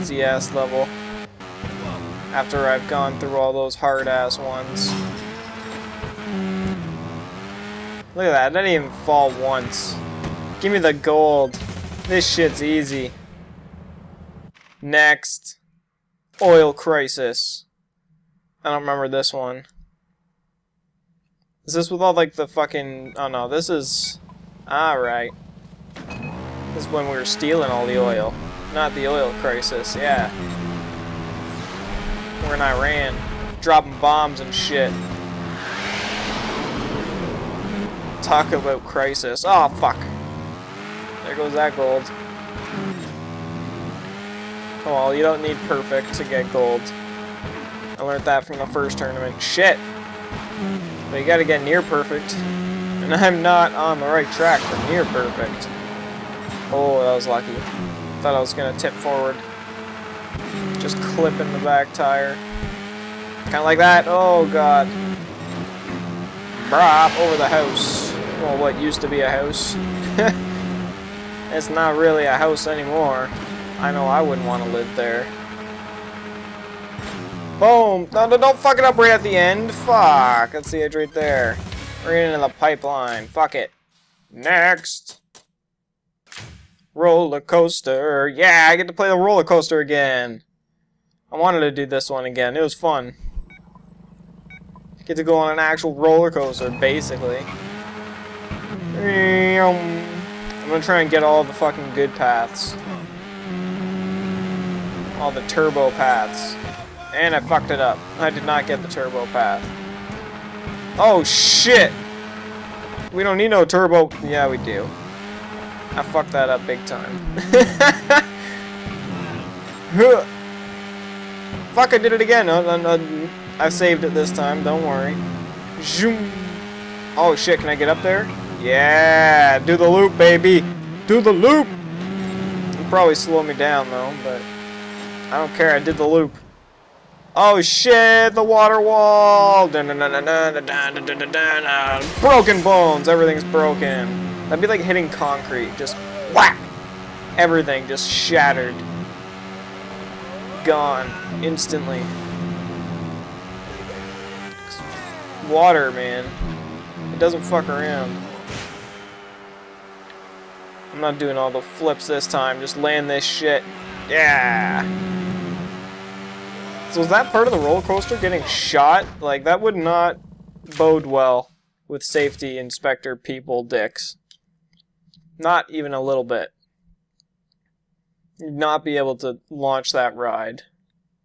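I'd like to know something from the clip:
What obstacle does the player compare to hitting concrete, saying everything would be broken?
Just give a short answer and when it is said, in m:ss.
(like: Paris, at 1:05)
the water wall, at 2:18.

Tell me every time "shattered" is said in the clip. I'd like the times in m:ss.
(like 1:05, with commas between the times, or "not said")
2:28.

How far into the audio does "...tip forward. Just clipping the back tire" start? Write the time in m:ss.
0:58.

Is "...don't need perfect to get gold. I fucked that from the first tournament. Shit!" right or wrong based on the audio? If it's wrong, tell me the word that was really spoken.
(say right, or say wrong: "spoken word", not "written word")
wrong: "learned", not "fucked".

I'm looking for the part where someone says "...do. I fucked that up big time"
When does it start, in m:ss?
1:54.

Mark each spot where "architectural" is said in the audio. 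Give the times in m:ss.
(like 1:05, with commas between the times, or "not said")
not said.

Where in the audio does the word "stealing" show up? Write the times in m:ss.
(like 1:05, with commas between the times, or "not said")
0:27.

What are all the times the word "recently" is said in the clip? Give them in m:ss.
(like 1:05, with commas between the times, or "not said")
not said.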